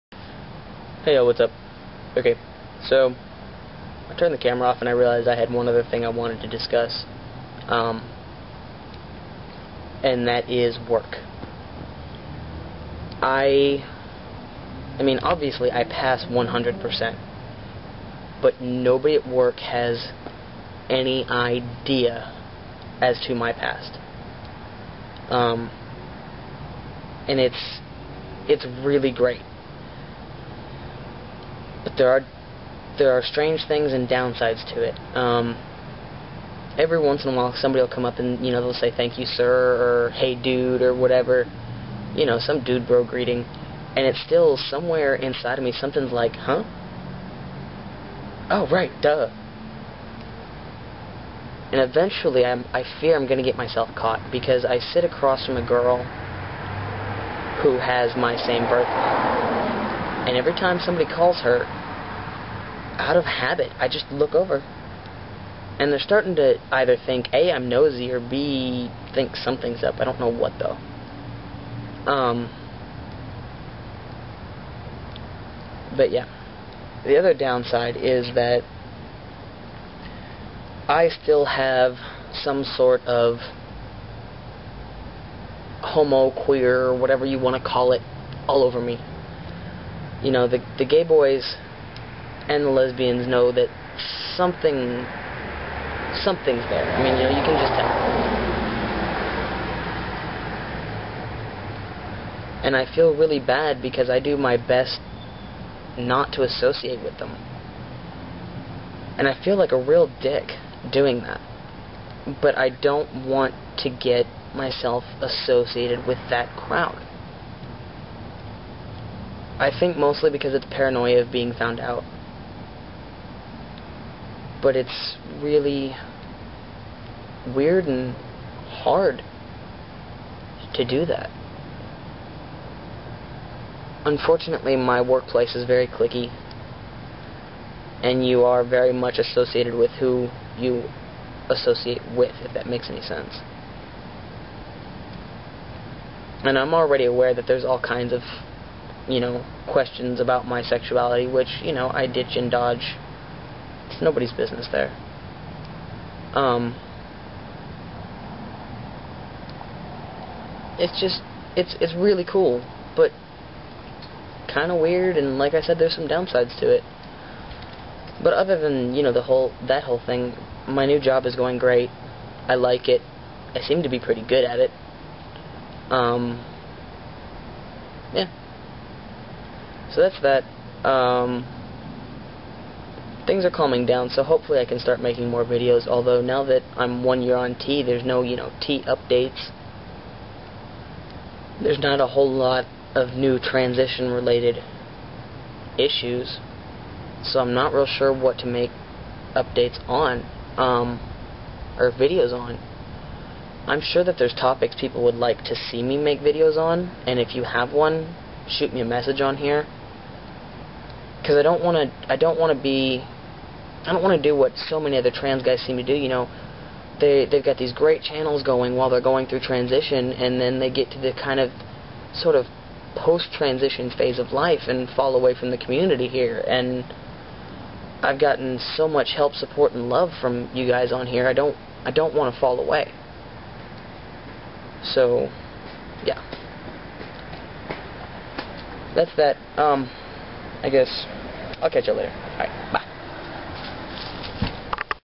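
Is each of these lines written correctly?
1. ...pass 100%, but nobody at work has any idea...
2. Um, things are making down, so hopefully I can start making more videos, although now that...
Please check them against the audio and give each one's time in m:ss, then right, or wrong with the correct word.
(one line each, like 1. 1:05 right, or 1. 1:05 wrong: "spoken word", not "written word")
1. 0:15 right
2. 3:00 wrong: "calming", not "making".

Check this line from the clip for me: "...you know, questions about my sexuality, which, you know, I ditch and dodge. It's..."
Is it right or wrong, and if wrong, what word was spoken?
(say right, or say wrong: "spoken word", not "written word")
right.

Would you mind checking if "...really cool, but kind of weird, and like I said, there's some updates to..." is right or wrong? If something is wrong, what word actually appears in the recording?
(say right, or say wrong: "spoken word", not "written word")
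wrong: "downsides", not "updates".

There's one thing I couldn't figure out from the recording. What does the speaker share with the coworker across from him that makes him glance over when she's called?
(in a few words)
same birthday.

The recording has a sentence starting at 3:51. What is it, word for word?
I don't I don't want to fall away.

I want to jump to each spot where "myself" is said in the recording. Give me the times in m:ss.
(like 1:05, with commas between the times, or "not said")
0:53, 1:54.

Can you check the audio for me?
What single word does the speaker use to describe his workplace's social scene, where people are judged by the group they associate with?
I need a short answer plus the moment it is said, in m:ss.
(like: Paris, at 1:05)
clicky, at 2:15.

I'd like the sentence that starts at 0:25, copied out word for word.
Um, and it's, it's really great but there are there are strange things and downsides to it.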